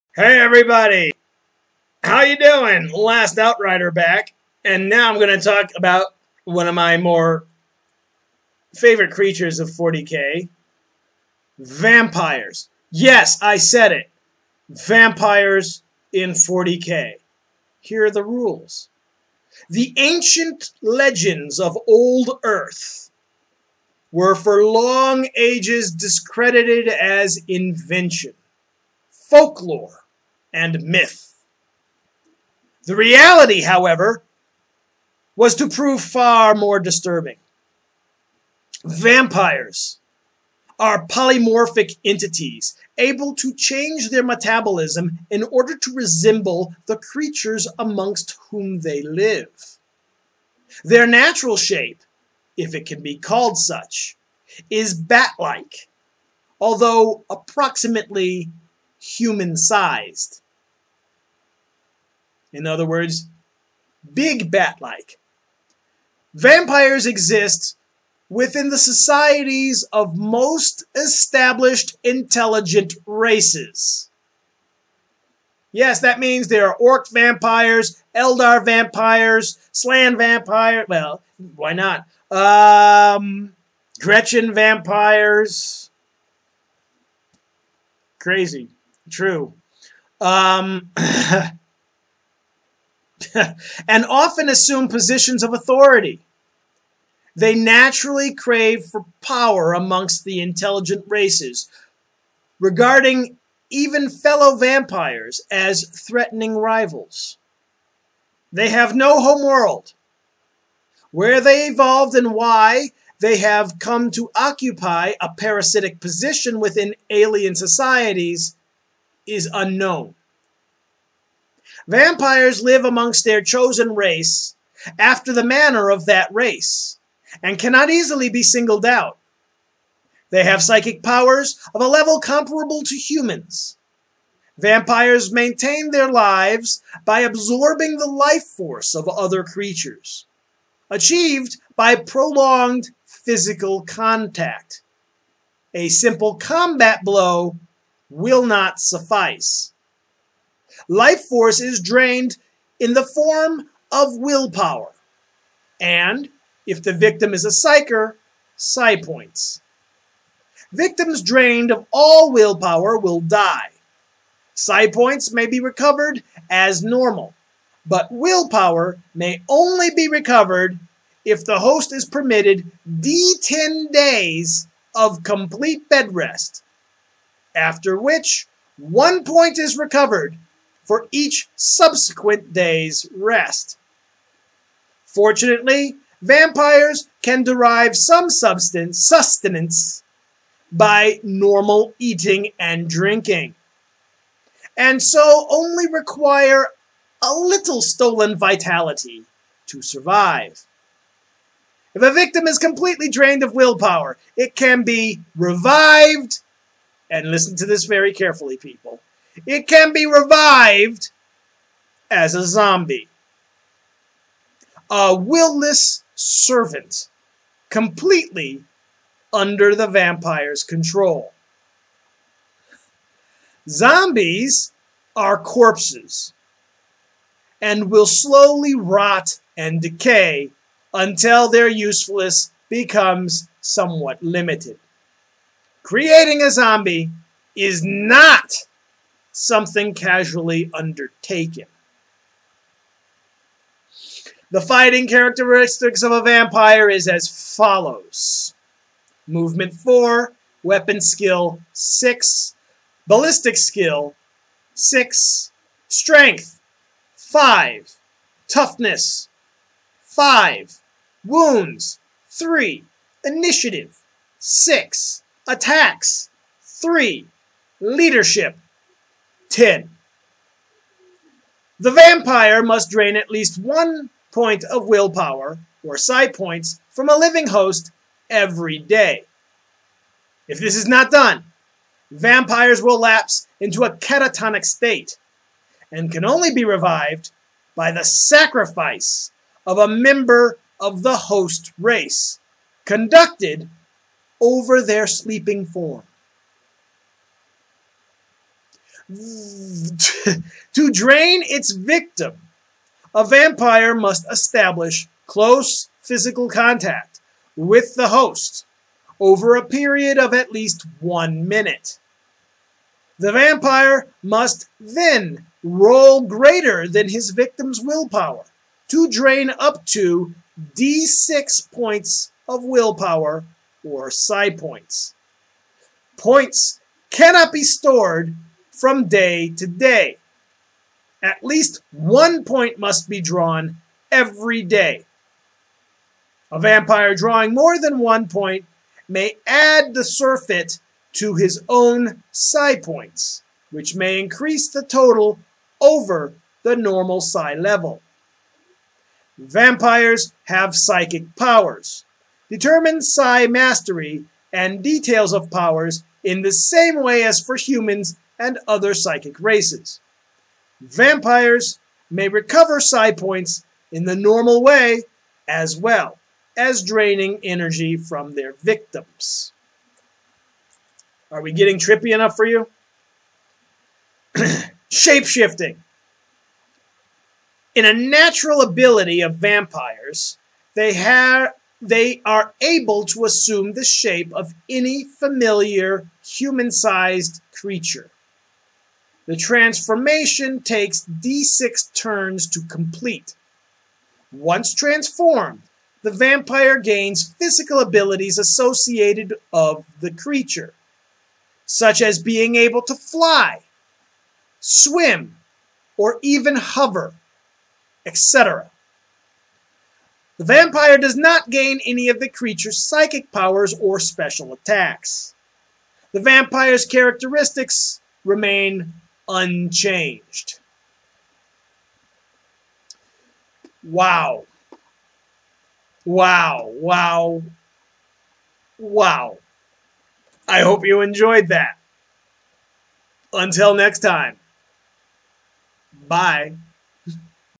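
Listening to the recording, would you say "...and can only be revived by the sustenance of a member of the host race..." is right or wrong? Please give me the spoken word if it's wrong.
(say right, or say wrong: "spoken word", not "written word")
wrong: "sacrifice", not "sustenance".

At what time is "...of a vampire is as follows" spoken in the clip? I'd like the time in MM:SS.
04:06.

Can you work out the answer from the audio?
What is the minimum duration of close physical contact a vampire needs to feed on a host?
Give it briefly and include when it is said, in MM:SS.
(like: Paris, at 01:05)
1 minute, at 05:11.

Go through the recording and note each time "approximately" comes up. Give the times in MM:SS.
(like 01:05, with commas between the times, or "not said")
00:57.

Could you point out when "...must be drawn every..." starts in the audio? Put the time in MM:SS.
05:32.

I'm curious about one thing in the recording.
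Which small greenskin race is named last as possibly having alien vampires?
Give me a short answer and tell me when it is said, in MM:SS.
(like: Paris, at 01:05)
Gretchin, at 01:24.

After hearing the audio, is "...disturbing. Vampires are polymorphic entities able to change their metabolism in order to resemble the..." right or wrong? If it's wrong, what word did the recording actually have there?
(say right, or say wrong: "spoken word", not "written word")
right.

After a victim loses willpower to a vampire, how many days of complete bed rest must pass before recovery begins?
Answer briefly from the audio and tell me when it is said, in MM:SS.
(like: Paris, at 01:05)
D10 days, at 02:52.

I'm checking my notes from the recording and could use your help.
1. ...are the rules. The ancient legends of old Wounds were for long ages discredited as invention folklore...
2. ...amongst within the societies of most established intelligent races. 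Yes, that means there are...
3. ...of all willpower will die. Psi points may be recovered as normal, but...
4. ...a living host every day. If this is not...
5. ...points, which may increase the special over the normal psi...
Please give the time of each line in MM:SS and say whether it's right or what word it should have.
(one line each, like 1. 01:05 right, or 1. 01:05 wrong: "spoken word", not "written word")
1. 00:18 wrong: "Earth", not "Wounds"
2. 01:07 wrong: "exist", not "amongst"
3. 02:41 right
4. 04:37 right
5. 05:42 wrong: "total", not "special".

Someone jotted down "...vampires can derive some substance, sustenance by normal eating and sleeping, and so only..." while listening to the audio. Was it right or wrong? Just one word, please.
wrong.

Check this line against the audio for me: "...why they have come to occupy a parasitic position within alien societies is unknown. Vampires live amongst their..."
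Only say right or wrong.
right.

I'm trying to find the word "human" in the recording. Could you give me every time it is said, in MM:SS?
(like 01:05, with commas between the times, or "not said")
00:58, 02:12, 05:57, 06:26.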